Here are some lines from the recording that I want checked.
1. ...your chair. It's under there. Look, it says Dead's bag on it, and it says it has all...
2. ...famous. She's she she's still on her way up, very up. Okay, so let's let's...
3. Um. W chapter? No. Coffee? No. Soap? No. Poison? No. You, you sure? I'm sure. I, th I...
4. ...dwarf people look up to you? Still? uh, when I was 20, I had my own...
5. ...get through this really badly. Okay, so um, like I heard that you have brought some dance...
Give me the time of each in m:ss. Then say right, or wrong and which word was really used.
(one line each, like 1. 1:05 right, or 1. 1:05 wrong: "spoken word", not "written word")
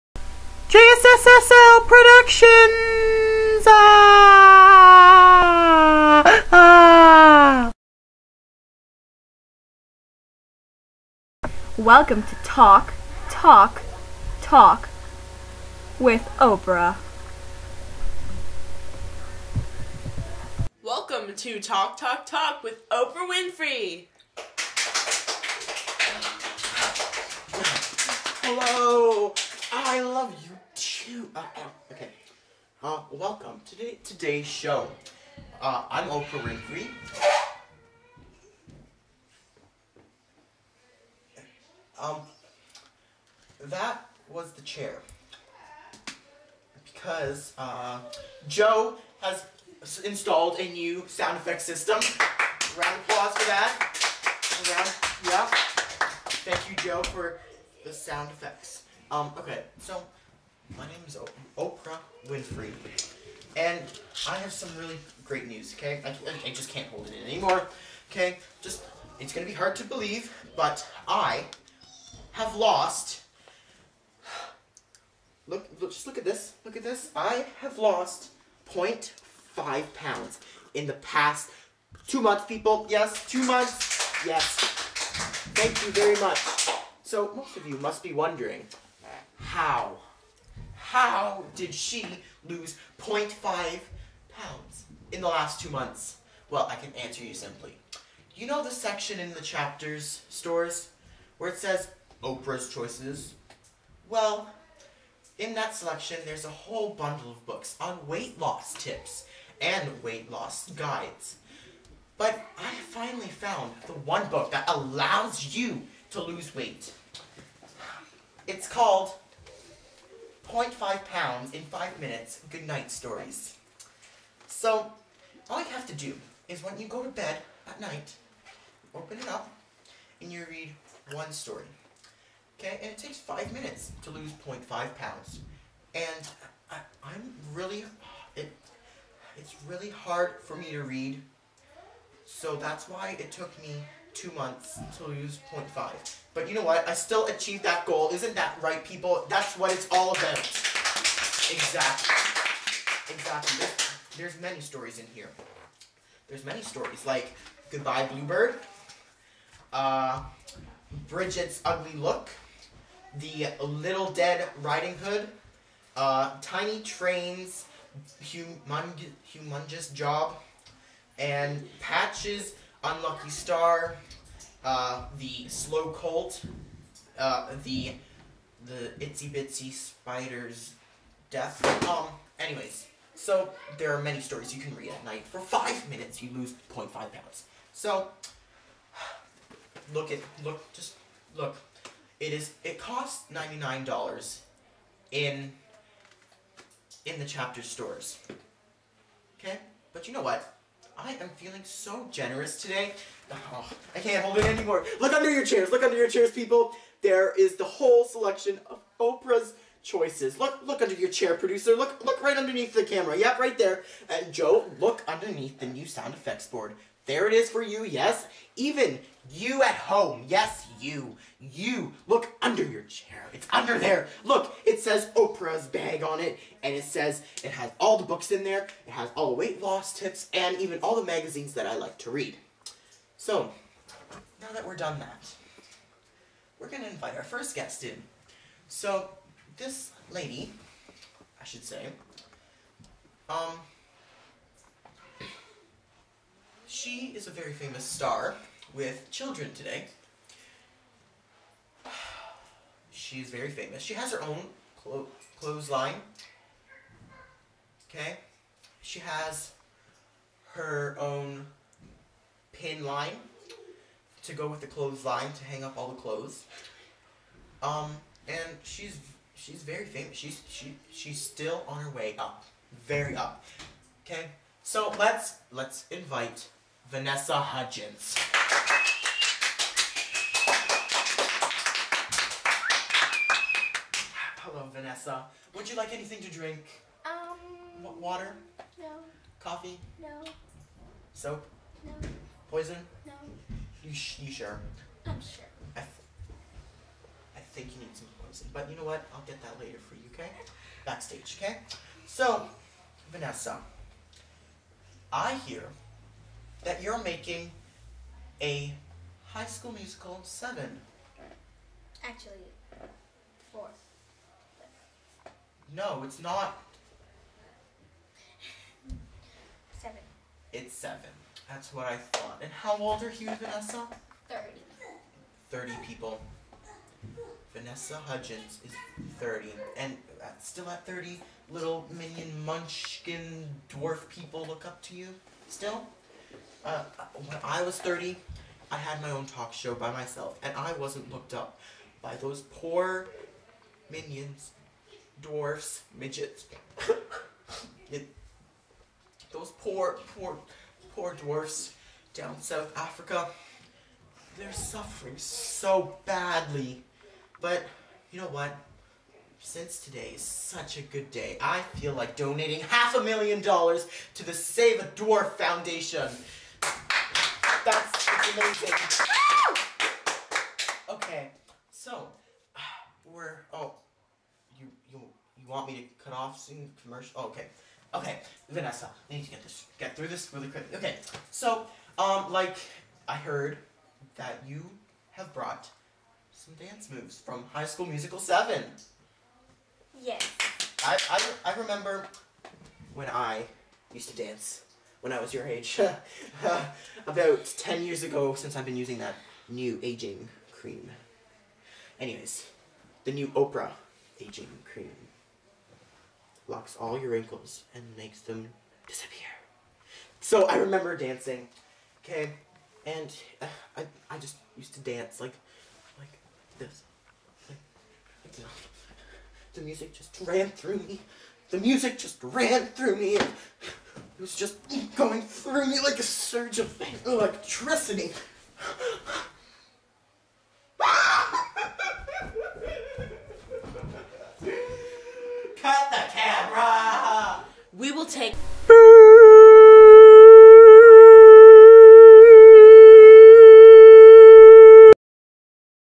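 1. 3:42 wrong: "Oprah", not "Dead"
2. 4:29 right
3. 4:47 wrong: "water", not "chapter"
4. 5:33 wrong: "30", not "20"
5. 6:19 wrong: "quickly", not "badly".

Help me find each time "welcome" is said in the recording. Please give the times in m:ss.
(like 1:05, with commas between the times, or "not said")
0:11, 0:20, 0:33.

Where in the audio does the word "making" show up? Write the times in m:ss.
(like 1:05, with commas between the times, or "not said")
5:07.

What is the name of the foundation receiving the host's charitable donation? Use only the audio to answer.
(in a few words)
Save a Dwarf Foundation.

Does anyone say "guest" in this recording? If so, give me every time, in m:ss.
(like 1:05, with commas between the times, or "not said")
3:57.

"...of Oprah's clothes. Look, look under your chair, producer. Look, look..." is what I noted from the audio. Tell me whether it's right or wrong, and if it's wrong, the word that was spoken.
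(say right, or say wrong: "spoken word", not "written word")
wrong: "choices", not "clothes".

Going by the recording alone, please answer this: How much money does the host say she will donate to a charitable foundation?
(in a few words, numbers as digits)
half a million dollars.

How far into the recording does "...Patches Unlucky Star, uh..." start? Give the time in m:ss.
2:51.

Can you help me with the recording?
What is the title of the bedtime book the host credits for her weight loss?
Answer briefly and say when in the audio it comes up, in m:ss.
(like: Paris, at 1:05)
0.5 pounds in 5 minutes good night stories, at 2:00.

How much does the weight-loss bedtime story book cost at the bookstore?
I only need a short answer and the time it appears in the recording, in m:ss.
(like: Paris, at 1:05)
$99, at 3:13.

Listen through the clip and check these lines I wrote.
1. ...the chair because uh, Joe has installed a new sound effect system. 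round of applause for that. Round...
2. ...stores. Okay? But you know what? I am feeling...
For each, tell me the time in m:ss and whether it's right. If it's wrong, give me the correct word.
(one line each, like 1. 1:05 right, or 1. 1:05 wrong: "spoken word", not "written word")
1. 0:44 right
2. 3:17 right.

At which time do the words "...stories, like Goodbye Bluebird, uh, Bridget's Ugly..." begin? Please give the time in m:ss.
2:36.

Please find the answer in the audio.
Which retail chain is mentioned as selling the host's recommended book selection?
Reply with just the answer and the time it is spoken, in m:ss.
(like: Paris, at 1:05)
Chapters, at 1:39.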